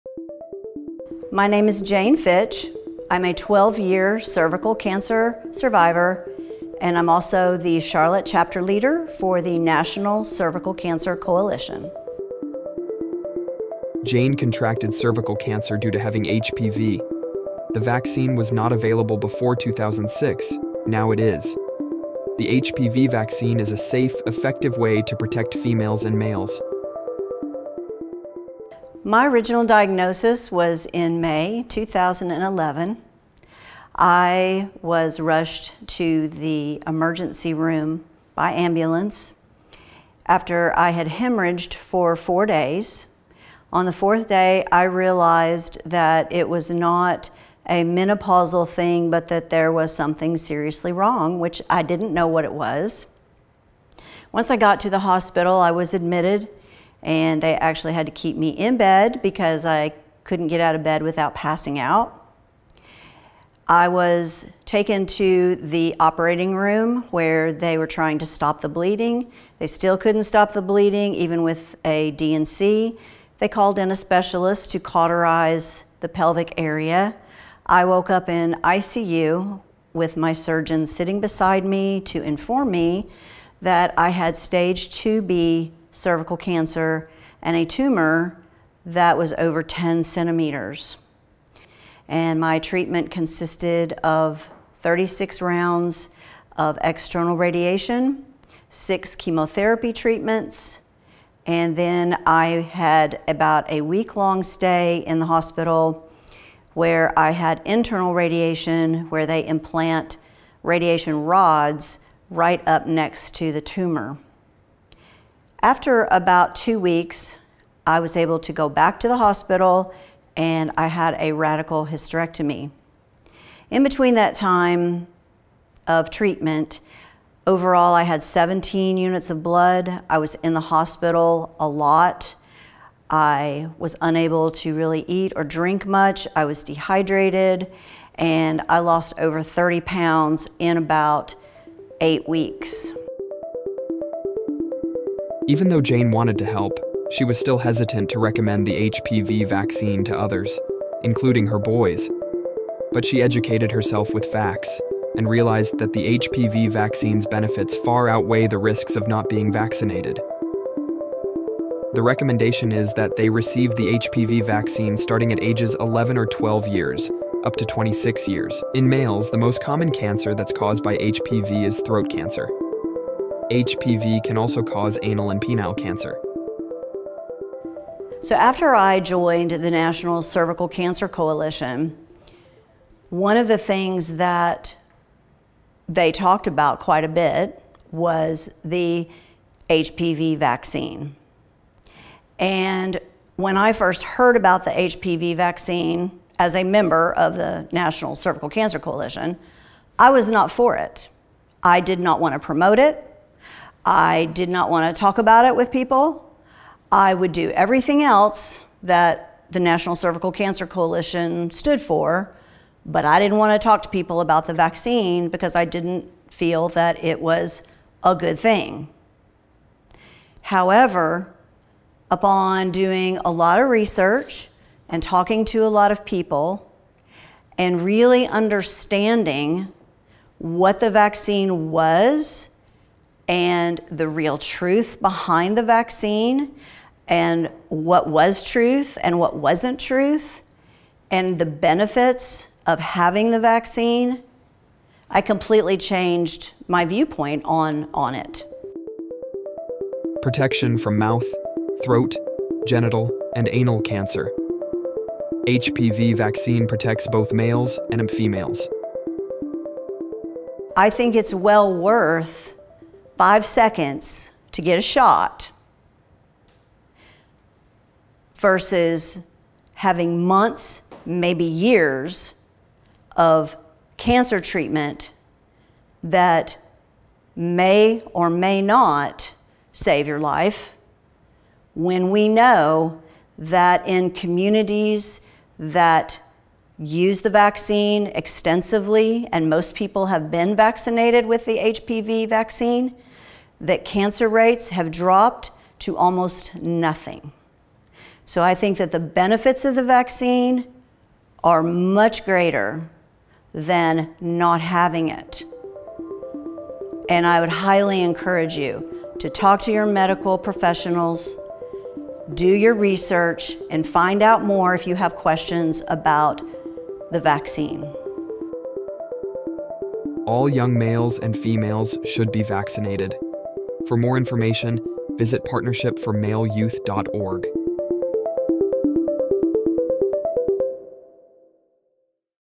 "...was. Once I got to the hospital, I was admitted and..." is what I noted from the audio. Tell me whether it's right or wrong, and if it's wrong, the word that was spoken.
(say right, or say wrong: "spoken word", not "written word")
right.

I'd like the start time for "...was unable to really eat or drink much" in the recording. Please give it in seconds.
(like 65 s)
133 s.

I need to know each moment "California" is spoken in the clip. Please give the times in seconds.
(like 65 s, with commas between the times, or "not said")
not said.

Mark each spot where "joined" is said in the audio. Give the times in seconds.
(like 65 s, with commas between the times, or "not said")
179 s.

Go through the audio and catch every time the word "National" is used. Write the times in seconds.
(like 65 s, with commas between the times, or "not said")
9 s, 179 s, 197 s, 209 s.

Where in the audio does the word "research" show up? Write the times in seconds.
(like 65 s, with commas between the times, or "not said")
223 s, 312 s.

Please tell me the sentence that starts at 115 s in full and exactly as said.
After about two weeks, I was able to go back to the hospital and I had a radical hysterectomy.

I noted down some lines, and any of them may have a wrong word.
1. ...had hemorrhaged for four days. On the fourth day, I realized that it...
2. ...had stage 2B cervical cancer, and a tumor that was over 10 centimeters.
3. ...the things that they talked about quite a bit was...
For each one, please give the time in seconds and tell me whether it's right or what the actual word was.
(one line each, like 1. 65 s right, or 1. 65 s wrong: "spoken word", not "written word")
1. 40 s right
2. 84 s right
3. 183 s right.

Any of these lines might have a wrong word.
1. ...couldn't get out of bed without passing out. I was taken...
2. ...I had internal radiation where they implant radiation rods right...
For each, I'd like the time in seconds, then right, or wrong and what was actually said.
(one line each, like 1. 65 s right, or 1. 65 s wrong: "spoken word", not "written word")
1. 60 s right
2. 107 s right.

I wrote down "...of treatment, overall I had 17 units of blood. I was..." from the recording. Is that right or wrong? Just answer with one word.
right.